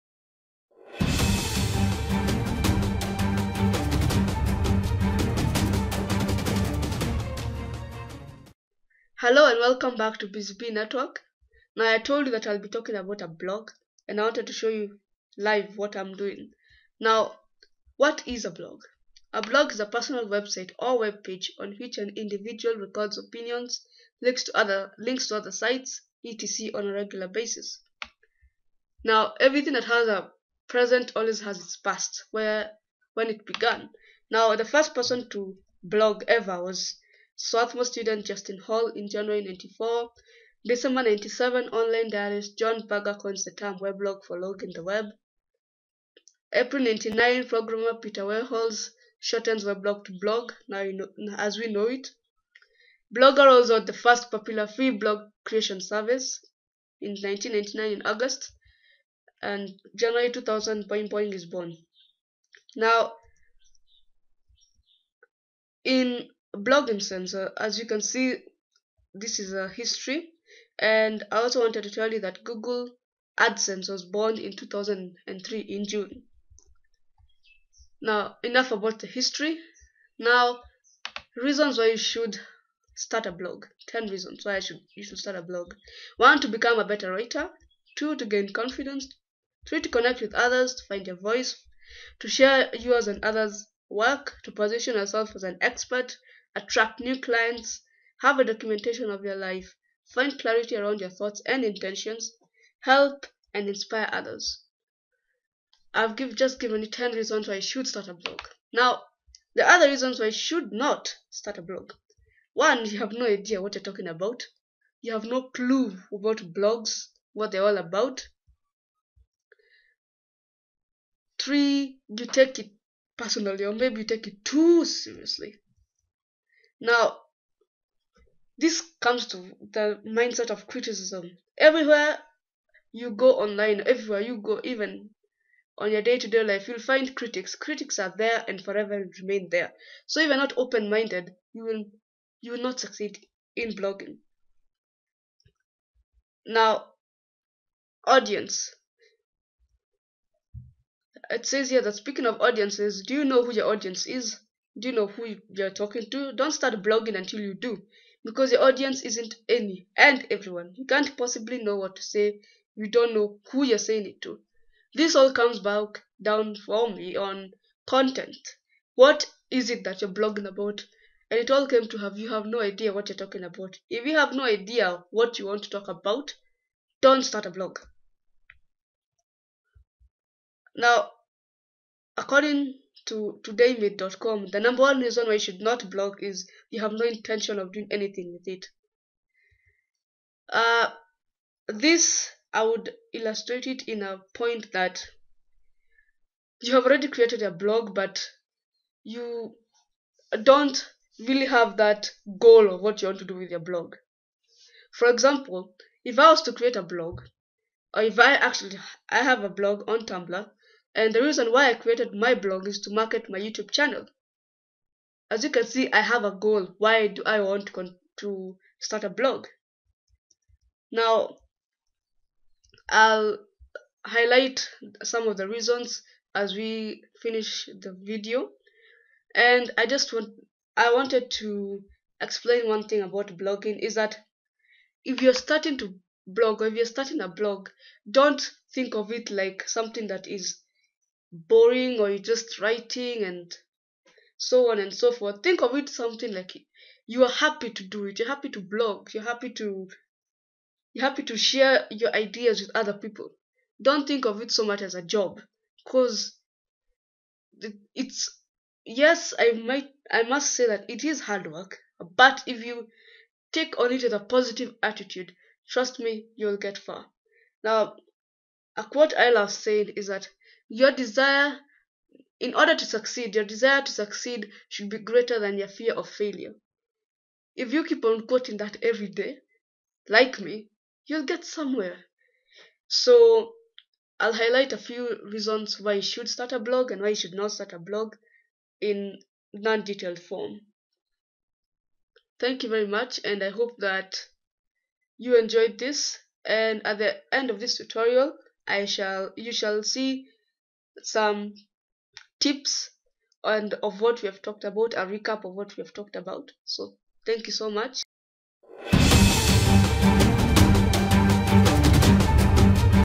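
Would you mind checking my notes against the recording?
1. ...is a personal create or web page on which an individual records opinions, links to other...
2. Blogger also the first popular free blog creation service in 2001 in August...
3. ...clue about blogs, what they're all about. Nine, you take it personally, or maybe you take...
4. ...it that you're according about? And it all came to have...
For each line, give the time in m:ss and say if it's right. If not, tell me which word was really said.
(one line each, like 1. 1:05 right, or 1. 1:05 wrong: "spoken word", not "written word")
1. 0:19 wrong: "website", not "create"
2. 0:53 wrong: "1999", not "2001"
3. 1:55 wrong: "Three", not "Nine"
4. 2:49 wrong: "blogging", not "according".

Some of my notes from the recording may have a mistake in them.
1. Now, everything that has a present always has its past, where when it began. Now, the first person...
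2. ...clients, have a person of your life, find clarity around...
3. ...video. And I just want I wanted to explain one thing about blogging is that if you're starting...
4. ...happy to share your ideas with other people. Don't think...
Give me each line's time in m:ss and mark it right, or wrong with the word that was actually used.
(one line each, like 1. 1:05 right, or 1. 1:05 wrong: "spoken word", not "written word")
1. 0:29 right
2. 1:37 wrong: "documentation", not "person"
3. 3:48 right
4. 4:11 right.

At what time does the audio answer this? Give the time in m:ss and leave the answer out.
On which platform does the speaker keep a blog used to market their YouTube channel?
3:30.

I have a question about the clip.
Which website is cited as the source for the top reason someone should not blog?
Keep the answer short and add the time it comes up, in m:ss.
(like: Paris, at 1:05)
todaymate.com, at 3:03.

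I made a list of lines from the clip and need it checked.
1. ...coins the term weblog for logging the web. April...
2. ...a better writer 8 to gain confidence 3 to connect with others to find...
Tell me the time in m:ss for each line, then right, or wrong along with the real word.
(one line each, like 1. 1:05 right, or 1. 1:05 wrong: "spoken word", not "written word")
1. 0:43 right
2. 1:26 wrong: "2", not "8".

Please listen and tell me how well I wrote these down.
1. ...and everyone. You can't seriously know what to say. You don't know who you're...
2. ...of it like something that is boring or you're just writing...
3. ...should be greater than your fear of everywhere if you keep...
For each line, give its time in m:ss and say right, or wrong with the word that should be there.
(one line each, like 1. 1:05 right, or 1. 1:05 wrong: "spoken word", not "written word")
1. 2:39 wrong: "possibly", not "seriously"
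2. 3:58 right
3. 4:34 wrong: "failure", not "everywhere".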